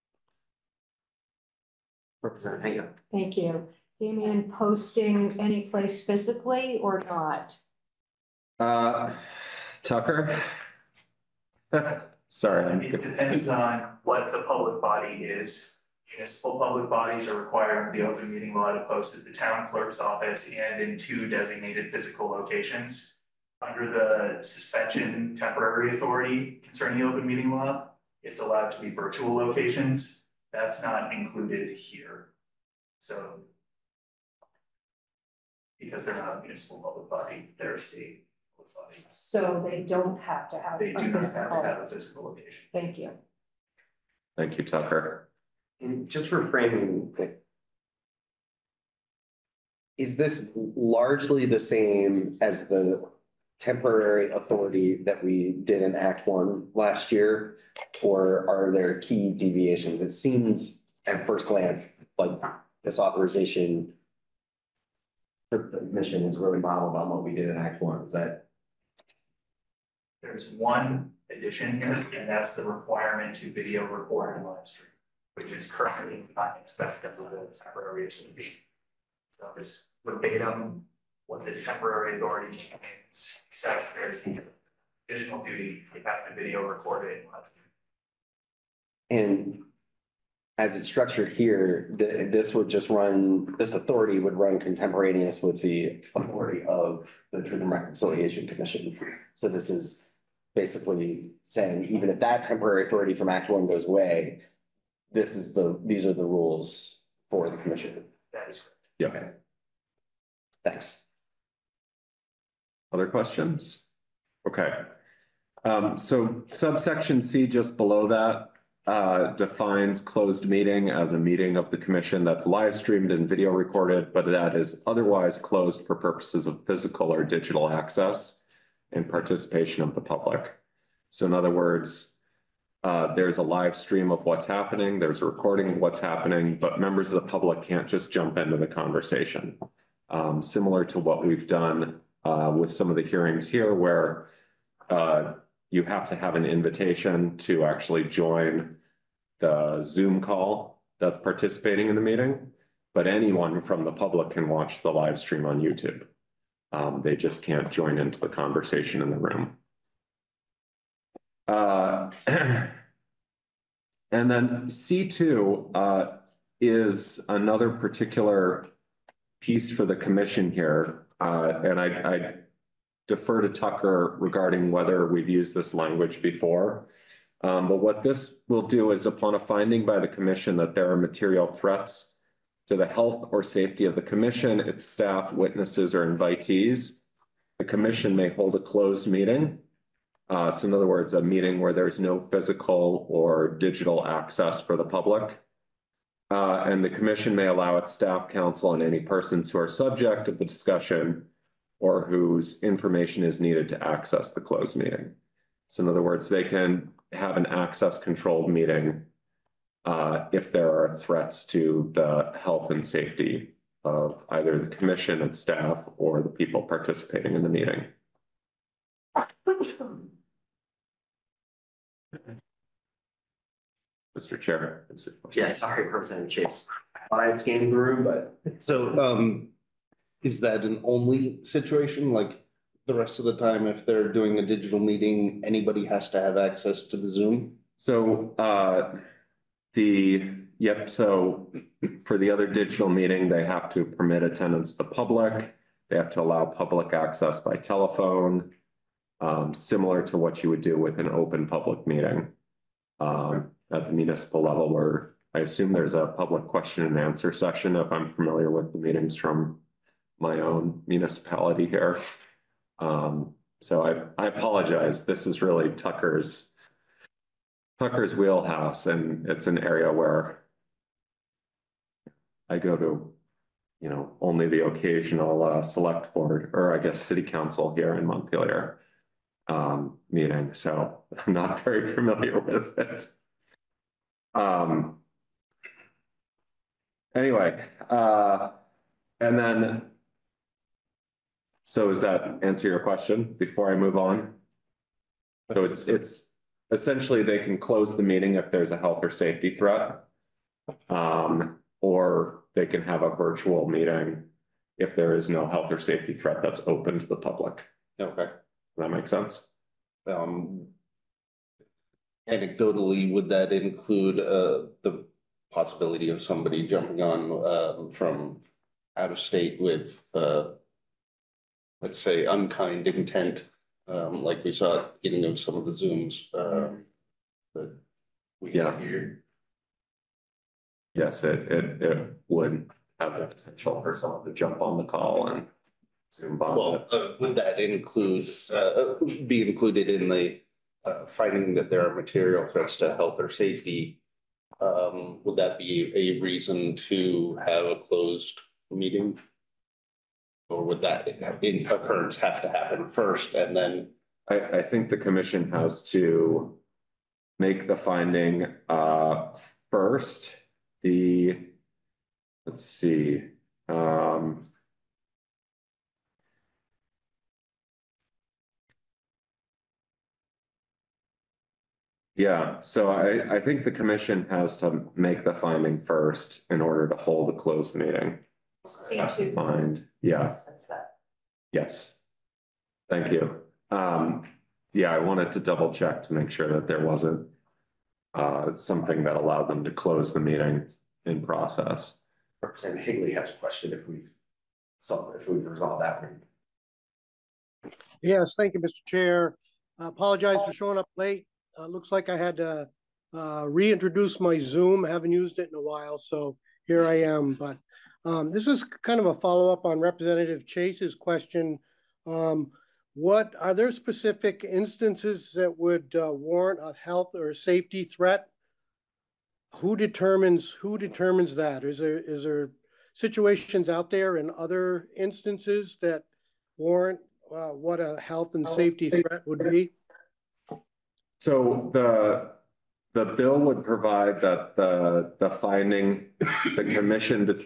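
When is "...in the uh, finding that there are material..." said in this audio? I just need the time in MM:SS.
05:39.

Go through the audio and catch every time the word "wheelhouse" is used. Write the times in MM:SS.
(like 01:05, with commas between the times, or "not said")
04:28.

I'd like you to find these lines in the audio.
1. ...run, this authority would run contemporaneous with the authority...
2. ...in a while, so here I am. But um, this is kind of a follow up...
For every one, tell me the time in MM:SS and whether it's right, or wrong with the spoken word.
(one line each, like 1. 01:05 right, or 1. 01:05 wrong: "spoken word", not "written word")
1. 01:32 right
2. 06:45 right.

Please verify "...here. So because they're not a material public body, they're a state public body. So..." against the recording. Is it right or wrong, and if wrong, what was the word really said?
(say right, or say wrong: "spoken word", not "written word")
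wrong: "municipal", not "material".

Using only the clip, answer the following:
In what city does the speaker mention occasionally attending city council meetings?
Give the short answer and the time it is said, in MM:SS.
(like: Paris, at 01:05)
Montpelier, at 04:38.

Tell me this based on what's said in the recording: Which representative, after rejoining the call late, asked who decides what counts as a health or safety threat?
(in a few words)
Representative Higley.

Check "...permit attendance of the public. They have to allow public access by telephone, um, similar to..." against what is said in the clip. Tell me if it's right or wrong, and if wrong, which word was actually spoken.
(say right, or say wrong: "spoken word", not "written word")
right.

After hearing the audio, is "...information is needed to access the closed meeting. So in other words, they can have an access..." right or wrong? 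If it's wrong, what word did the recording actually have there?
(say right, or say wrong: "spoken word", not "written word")
right.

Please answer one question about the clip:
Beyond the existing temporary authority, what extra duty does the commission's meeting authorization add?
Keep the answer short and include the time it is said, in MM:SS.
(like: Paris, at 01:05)
Video record and live stream, at 01:13.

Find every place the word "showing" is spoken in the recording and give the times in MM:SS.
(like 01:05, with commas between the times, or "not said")
06:40.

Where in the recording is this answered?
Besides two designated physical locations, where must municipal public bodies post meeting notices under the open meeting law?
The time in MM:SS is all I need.
00:19.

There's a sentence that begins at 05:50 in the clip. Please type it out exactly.
Or would that occurrence have to happen first and then?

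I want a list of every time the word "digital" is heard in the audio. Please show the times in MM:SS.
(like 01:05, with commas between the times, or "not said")
02:07, 03:13, 03:54, 04:02.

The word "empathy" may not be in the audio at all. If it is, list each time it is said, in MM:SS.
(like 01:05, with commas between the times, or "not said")
not said.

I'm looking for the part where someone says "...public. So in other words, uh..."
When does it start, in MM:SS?
02:10.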